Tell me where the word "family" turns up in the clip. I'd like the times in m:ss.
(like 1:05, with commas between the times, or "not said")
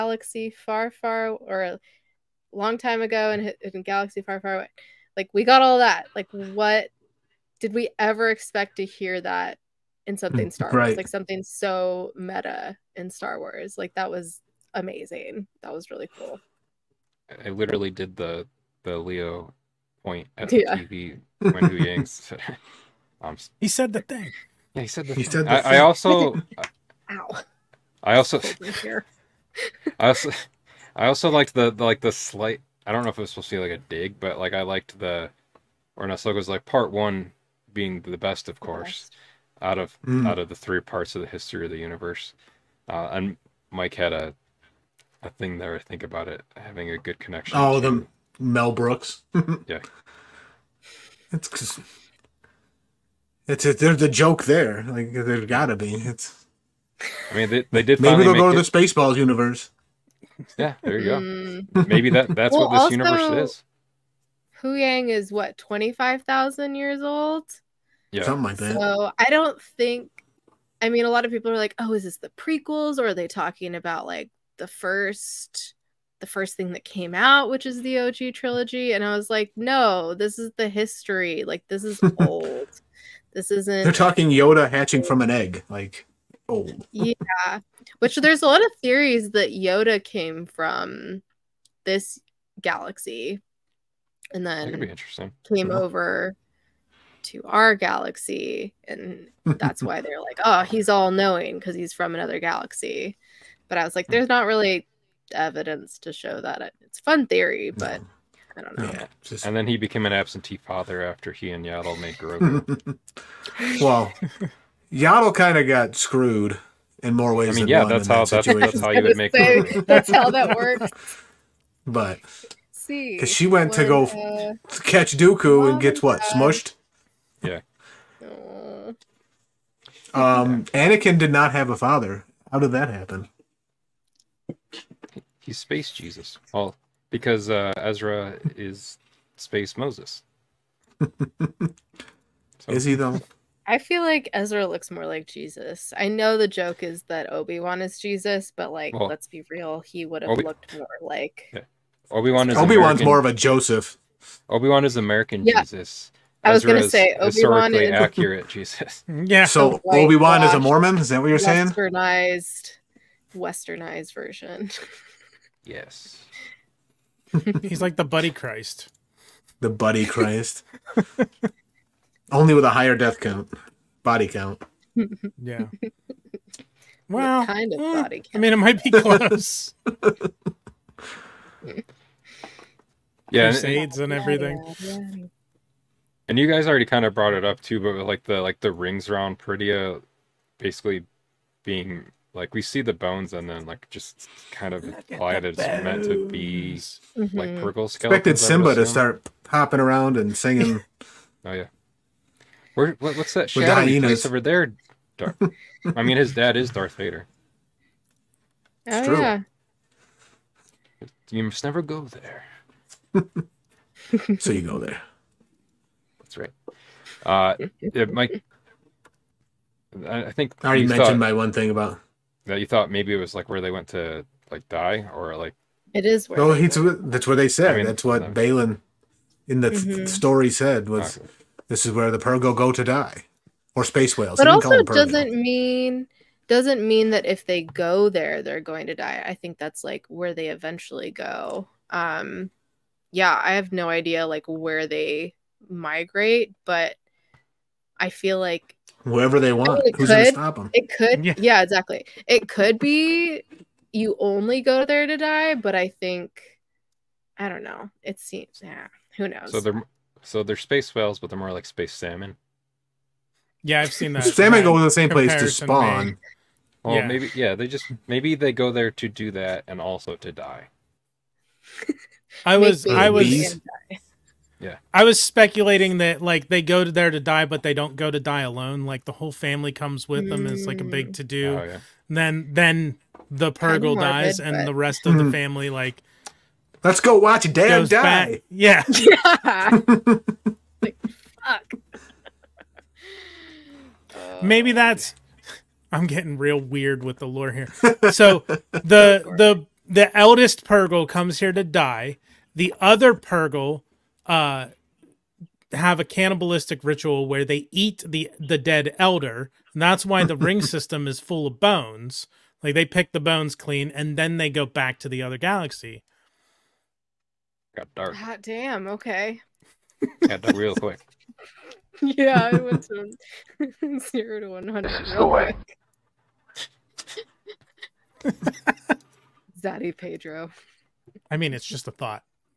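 4:39, 4:45.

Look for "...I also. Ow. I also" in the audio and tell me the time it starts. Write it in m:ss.
0:25.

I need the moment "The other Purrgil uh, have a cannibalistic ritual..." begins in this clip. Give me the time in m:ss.
5:02.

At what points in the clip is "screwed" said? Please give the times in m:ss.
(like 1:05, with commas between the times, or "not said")
1:55.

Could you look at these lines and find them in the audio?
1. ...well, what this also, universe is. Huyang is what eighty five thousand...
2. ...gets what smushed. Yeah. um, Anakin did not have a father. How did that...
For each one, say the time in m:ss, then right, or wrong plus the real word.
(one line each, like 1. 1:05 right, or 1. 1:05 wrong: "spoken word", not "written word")
1. 1:02 wrong: "twenty", not "eighty"
2. 2:05 right.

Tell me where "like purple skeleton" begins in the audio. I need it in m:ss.
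3:17.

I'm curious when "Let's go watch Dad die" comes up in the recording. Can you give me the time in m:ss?
4:46.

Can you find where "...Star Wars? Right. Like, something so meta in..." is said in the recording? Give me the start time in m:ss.
0:10.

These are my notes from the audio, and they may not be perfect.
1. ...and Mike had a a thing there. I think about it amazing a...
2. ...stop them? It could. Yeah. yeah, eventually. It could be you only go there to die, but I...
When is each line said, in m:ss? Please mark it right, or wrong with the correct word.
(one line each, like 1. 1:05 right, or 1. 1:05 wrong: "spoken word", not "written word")
1. 0:43 wrong: "having", not "amazing"
2. 4:10 wrong: "exactly", not "eventually".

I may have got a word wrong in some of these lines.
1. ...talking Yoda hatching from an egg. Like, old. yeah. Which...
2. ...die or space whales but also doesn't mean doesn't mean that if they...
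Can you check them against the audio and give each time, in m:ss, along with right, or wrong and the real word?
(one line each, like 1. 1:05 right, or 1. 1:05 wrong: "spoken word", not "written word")
1. 1:23 right
2. 3:52 right.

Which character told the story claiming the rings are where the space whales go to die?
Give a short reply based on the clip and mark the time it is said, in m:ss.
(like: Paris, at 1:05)
Baylan, at 3:48.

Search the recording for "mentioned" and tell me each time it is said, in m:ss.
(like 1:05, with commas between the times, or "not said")
3:40.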